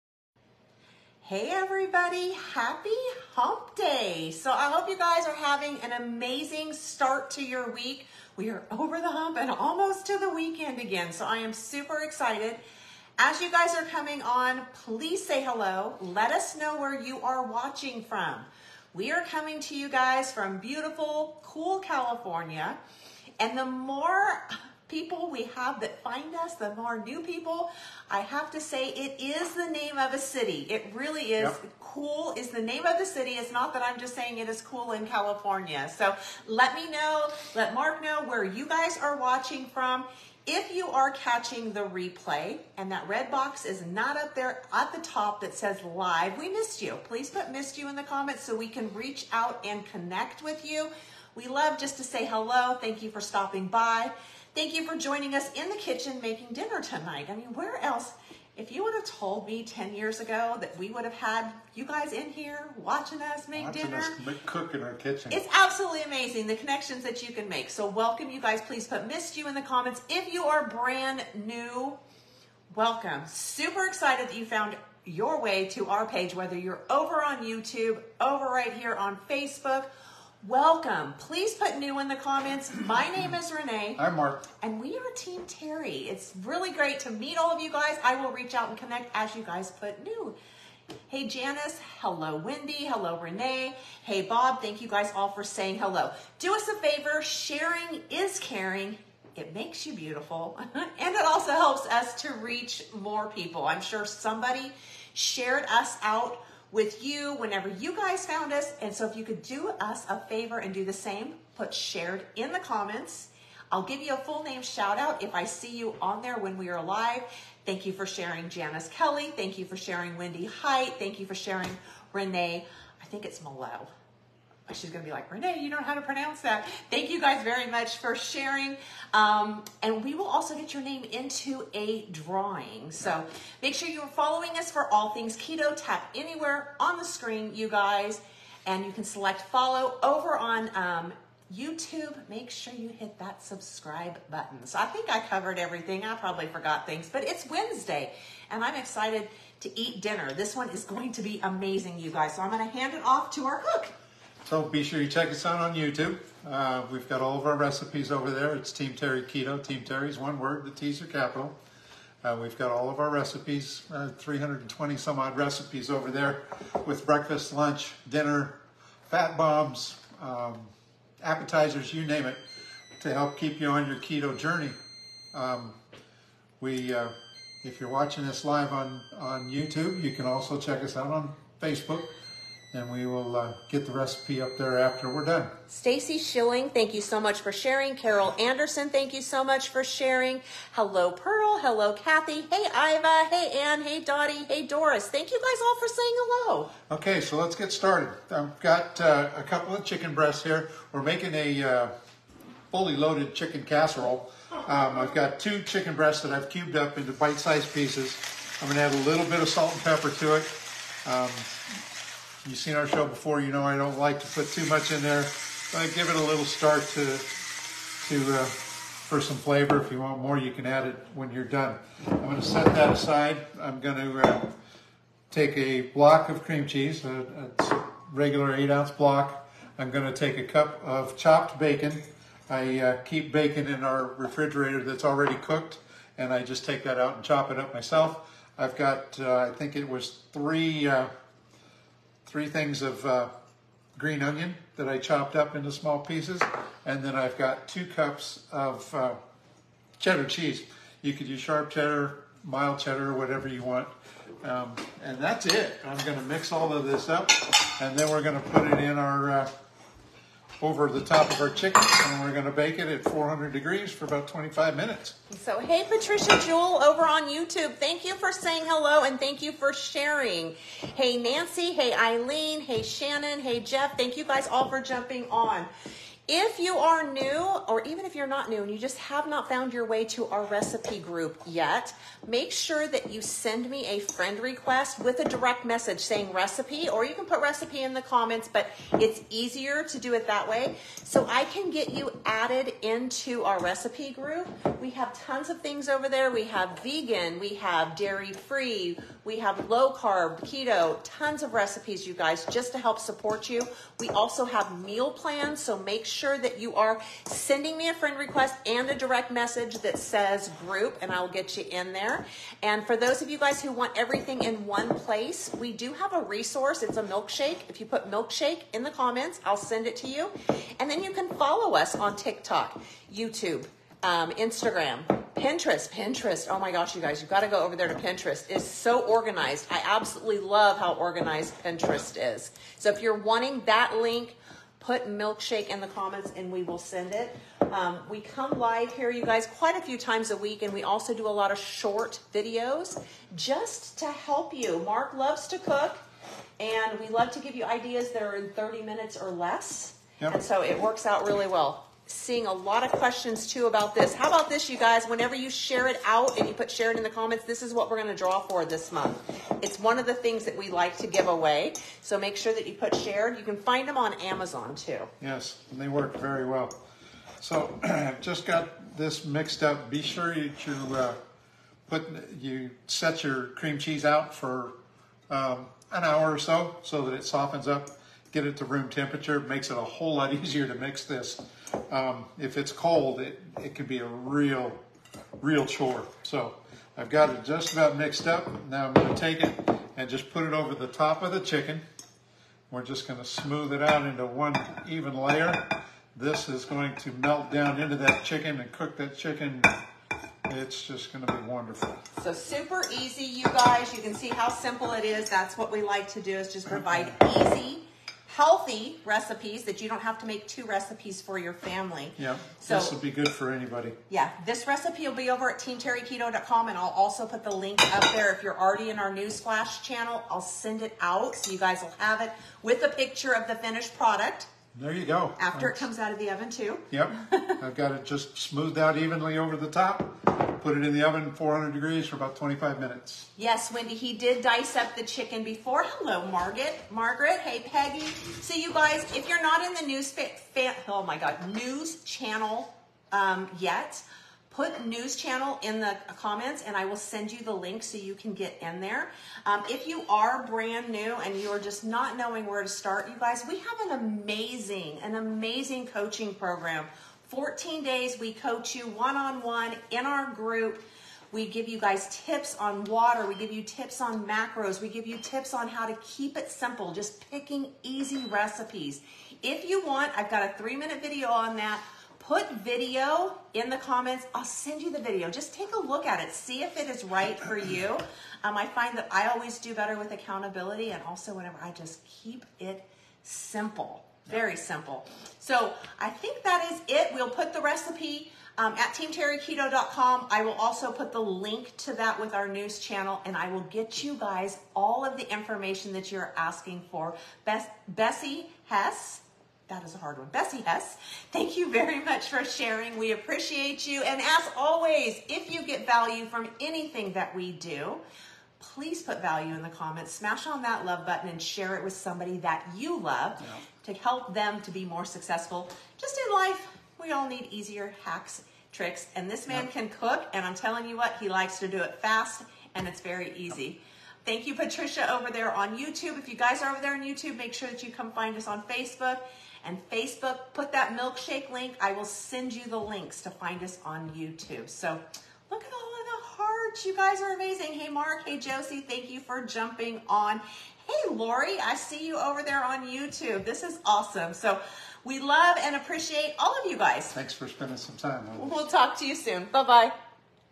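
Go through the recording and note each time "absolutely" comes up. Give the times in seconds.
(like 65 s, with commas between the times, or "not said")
65 s, 329 s.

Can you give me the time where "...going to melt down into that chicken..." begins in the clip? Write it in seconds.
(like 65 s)
396 s.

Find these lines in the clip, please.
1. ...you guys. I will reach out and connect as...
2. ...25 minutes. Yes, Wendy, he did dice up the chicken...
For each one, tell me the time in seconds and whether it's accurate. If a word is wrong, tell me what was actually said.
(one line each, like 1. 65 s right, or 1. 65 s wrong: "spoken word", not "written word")
1. 87 s right
2. 432 s right.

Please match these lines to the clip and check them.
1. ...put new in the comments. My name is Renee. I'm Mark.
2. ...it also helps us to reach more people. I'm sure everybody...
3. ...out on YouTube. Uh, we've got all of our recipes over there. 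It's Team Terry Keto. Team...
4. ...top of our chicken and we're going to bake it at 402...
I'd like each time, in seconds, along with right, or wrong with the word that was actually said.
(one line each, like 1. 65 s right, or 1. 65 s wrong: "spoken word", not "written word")
1. 81 s right
2. 101 s wrong: "somebody", not "everybody"
3. 155 s right
4. 261 s wrong: "400", not "402".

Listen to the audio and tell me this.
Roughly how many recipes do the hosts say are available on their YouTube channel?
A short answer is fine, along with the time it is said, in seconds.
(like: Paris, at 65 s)
320, at 164 s.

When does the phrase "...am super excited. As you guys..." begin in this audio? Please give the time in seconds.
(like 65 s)
11 s.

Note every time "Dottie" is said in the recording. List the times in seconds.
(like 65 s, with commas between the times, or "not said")
193 s.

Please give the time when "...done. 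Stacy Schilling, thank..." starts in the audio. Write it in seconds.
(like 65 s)
185 s.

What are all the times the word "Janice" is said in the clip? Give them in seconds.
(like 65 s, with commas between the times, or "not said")
91 s, 118 s.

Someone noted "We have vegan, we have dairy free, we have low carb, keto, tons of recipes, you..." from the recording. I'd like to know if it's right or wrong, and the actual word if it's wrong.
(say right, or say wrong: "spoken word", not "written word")
right.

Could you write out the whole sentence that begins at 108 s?
And so if you could do us a favor and do the same, put shared in the comments.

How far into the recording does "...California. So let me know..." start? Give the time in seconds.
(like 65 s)
35 s.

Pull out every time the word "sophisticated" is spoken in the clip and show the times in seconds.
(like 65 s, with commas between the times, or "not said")
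not said.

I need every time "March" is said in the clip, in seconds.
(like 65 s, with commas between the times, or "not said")
not said.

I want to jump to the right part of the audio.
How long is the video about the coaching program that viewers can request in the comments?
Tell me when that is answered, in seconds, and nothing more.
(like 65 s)
470 s.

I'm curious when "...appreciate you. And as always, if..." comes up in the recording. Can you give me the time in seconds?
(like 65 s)
503 s.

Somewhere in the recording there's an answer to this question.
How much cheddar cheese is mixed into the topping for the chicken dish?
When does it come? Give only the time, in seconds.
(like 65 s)
247 s.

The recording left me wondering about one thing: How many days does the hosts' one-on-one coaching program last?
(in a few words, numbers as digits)
14 days.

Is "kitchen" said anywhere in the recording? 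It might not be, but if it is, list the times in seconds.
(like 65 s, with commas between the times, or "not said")
55 s, 64 s.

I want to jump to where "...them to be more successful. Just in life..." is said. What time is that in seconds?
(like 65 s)
514 s.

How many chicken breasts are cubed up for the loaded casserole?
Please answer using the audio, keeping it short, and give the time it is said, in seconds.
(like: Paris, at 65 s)
2, at 205 s.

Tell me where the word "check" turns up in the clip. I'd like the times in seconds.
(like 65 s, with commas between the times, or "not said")
155 s, 180 s.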